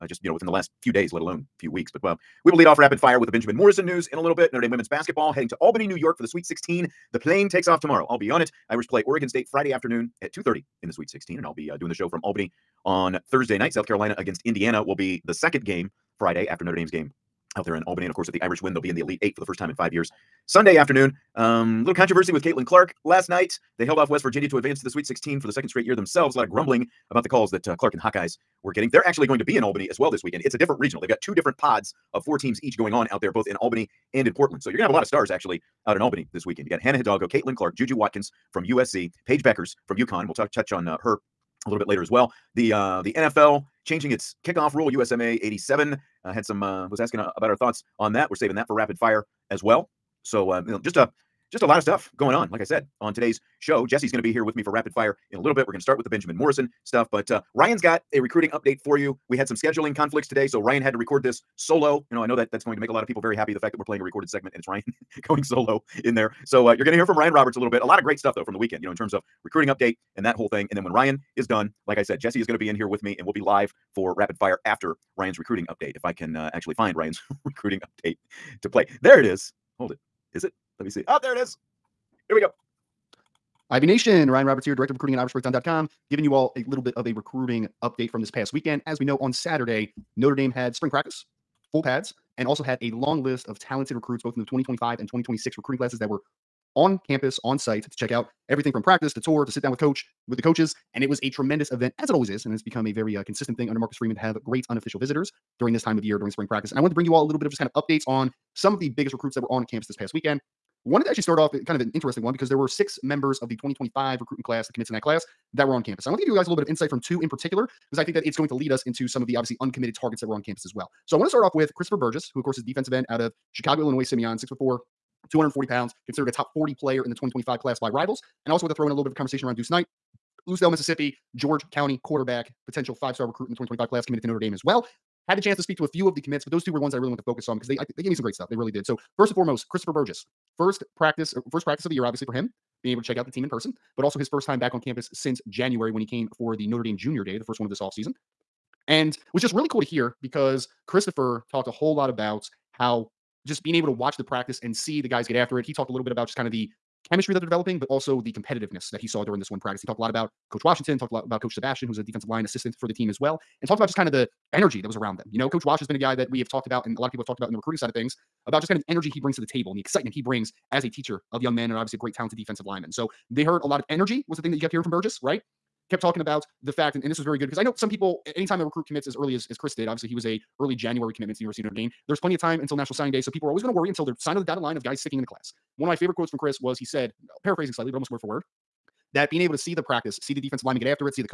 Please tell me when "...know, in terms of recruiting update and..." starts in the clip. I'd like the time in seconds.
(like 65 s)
68 s.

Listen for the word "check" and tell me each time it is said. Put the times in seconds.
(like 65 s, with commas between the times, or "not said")
97 s, 143 s.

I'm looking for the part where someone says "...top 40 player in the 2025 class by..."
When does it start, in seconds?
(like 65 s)
126 s.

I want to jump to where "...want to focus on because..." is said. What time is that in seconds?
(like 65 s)
137 s.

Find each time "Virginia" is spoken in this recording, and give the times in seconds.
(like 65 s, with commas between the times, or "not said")
24 s.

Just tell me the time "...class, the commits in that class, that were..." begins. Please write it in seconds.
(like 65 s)
114 s.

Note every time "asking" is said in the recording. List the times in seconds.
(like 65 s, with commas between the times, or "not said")
47 s.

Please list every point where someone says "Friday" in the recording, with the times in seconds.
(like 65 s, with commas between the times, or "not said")
9 s, 16 s.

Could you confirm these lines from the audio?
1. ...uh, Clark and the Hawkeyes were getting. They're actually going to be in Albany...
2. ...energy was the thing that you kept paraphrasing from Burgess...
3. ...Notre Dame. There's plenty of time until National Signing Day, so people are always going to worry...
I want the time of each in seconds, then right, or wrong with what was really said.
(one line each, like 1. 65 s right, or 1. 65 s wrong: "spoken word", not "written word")
1. 27 s right
2. 173 s wrong: "hearing", not "paraphrasing"
3. 181 s right.